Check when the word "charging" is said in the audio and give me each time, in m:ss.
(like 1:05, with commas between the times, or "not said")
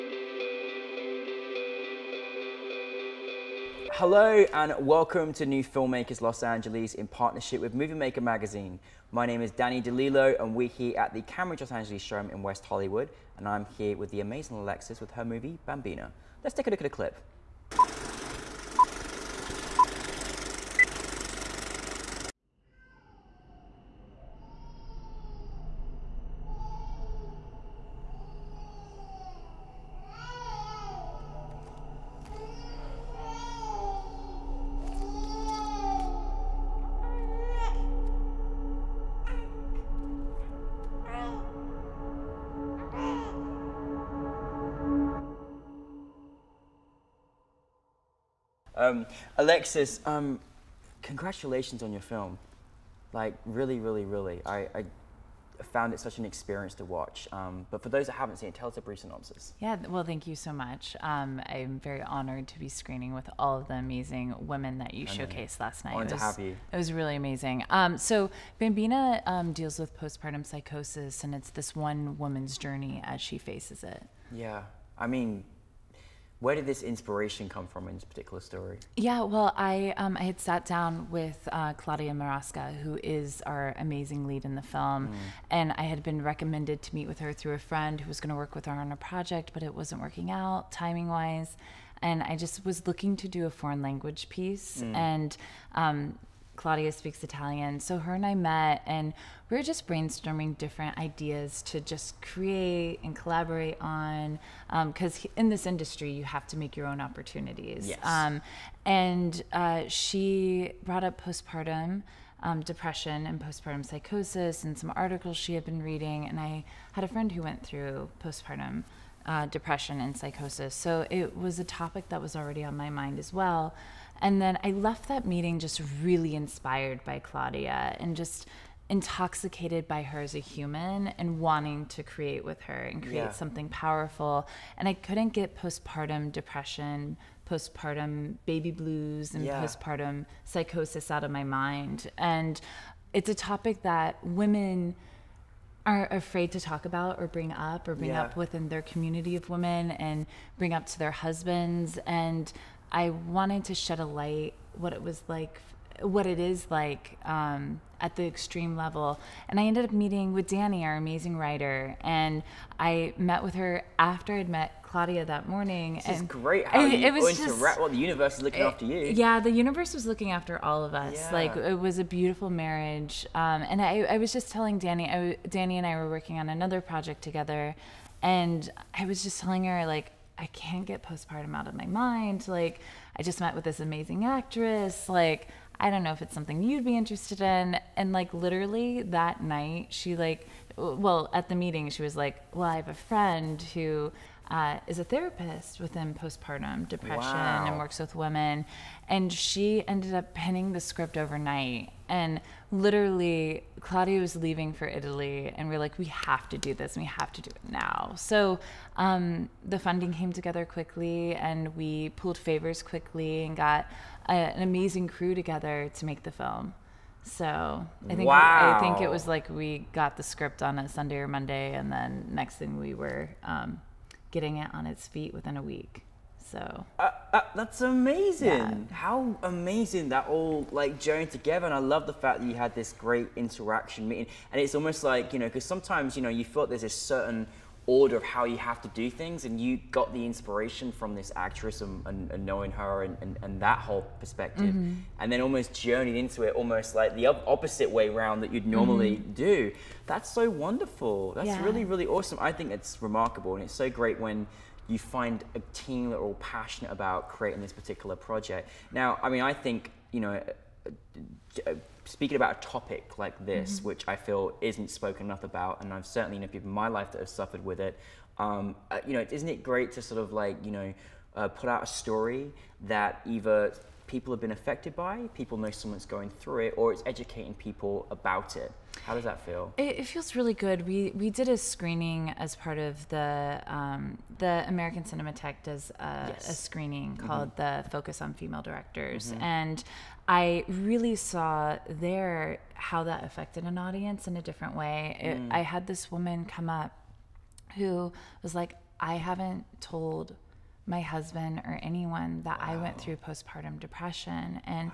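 not said.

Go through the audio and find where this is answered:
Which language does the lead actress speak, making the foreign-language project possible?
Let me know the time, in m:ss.
1:37.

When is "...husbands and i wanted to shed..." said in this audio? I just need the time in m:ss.
2:31.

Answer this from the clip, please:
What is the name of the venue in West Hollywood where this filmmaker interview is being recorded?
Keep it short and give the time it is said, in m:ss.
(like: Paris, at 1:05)
Cambridge Los Angeles Showroom, at 0:11.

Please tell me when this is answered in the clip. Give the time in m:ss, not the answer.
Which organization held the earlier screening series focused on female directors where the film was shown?
4:44.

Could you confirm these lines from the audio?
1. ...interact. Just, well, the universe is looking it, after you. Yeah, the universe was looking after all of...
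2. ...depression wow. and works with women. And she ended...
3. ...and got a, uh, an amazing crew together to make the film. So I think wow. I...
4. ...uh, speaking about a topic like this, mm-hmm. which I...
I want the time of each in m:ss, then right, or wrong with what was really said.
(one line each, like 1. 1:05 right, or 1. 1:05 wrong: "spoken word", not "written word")
1. 2:47 right
2. 3:16 right
3. 3:33 right
4. 4:21 right.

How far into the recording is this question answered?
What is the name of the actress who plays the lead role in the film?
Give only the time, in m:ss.
1:21.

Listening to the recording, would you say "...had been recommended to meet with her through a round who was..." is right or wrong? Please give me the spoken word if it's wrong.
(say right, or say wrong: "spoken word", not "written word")
wrong: "friend", not "round".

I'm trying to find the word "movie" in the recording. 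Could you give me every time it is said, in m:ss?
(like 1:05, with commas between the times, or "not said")
0:07, 0:15.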